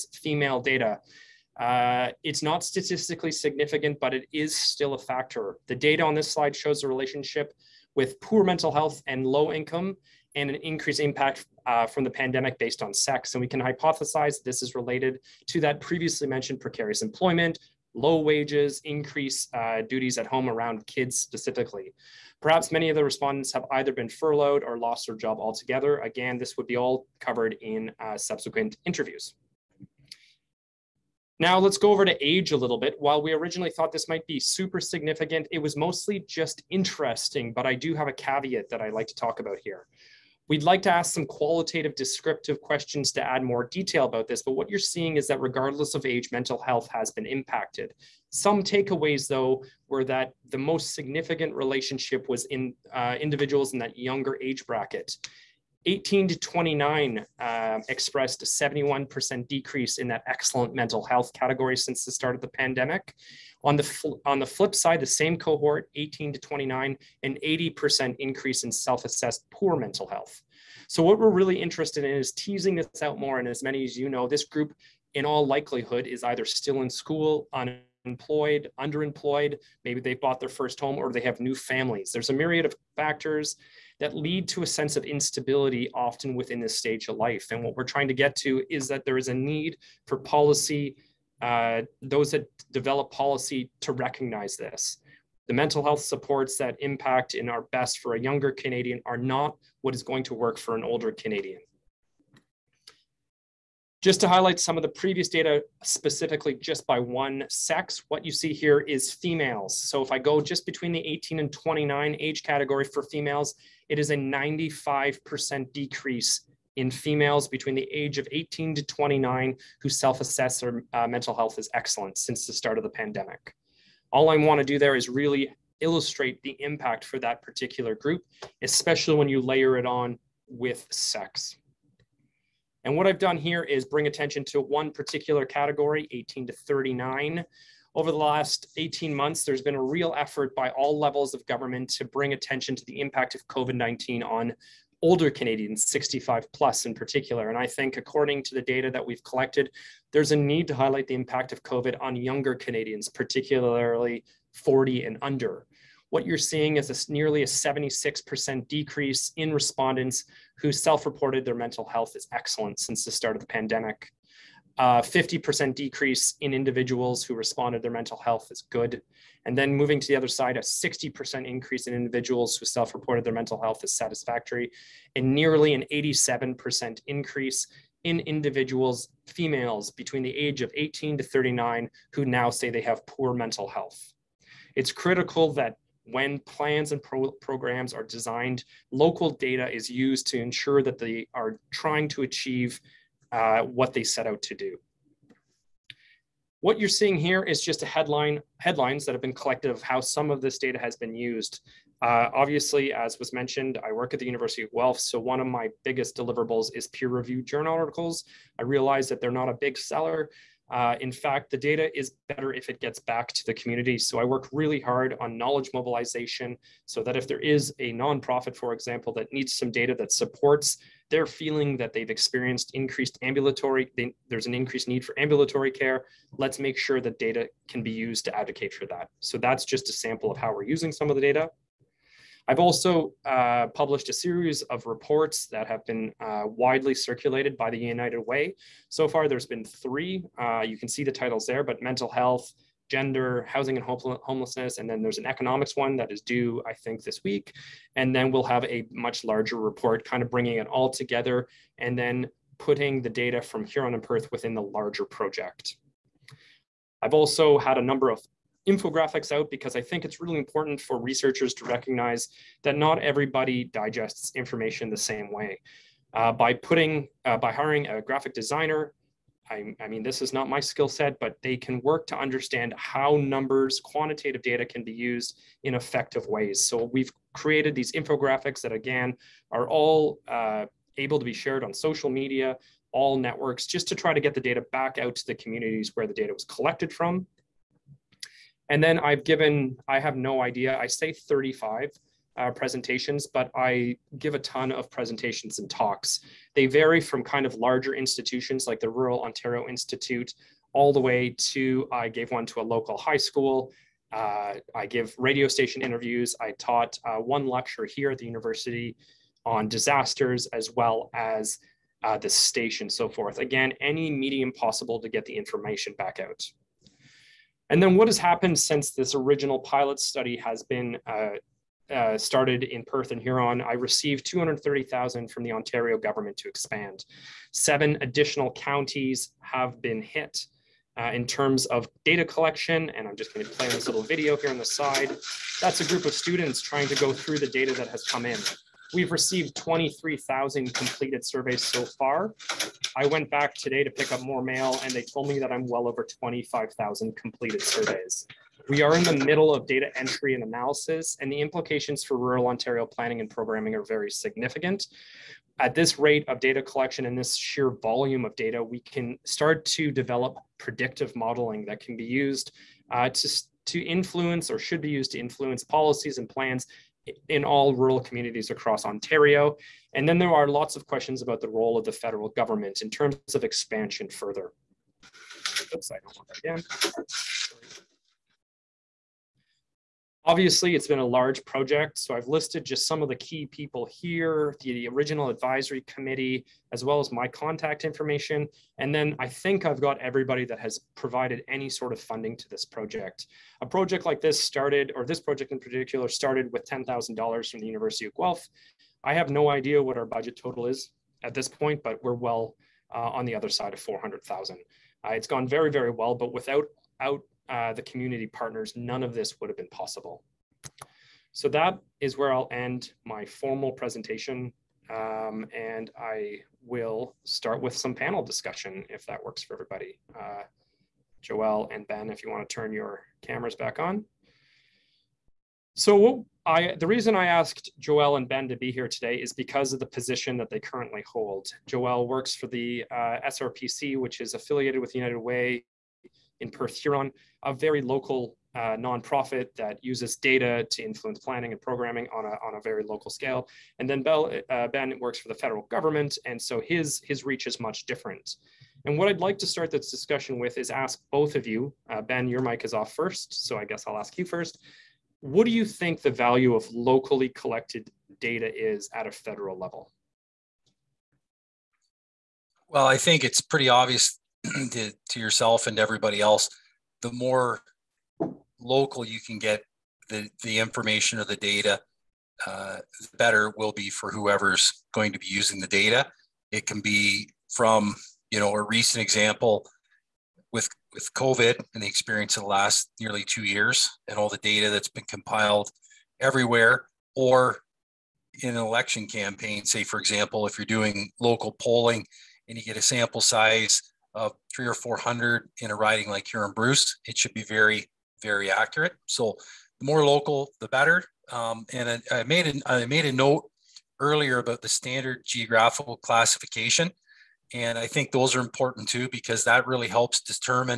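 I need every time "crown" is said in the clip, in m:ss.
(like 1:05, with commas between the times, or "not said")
not said.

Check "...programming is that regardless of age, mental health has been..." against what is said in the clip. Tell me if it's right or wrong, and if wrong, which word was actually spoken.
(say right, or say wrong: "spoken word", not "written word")
wrong: "seeing", not "programming".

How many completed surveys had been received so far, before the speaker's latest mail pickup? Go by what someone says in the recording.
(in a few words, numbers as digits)
23,000.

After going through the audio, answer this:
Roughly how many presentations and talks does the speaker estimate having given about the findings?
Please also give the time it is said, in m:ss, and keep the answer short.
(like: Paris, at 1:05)
35, at 4:51.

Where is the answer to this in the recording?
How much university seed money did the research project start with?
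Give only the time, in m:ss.
6:36.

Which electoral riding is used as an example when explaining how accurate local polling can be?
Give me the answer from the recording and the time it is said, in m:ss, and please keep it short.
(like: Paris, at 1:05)
Huron Bruce, at 8:16.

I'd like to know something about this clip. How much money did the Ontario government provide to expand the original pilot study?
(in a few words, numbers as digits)
230,000.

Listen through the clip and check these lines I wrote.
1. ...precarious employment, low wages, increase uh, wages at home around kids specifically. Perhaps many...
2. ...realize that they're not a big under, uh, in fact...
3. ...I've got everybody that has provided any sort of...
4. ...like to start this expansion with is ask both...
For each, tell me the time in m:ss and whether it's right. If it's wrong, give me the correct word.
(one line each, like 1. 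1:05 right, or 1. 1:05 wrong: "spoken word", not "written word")
1. 0:16 wrong: "duties", not "wages"
2. 3:28 wrong: "seller", not "under"
3. 6:29 right
4. 7:29 wrong: "discussion", not "expansion".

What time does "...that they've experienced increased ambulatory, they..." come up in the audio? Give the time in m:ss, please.
3:41.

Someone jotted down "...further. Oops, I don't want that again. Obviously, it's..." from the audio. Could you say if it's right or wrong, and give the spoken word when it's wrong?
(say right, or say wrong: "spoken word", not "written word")
right.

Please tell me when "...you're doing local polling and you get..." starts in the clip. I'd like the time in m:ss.
8:10.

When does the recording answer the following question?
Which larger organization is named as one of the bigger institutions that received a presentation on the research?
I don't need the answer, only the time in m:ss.
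4:58.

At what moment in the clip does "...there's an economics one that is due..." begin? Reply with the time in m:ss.
4:05.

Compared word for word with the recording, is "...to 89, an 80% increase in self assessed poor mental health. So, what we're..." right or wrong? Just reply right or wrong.
wrong.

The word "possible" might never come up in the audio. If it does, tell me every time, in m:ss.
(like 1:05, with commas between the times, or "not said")
5:14, 6:49.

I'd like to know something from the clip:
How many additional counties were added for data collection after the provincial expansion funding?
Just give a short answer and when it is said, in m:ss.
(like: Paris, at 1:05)
7, at 5:27.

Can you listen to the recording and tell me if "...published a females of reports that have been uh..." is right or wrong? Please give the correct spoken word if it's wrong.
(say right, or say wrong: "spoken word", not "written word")
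wrong: "series", not "females".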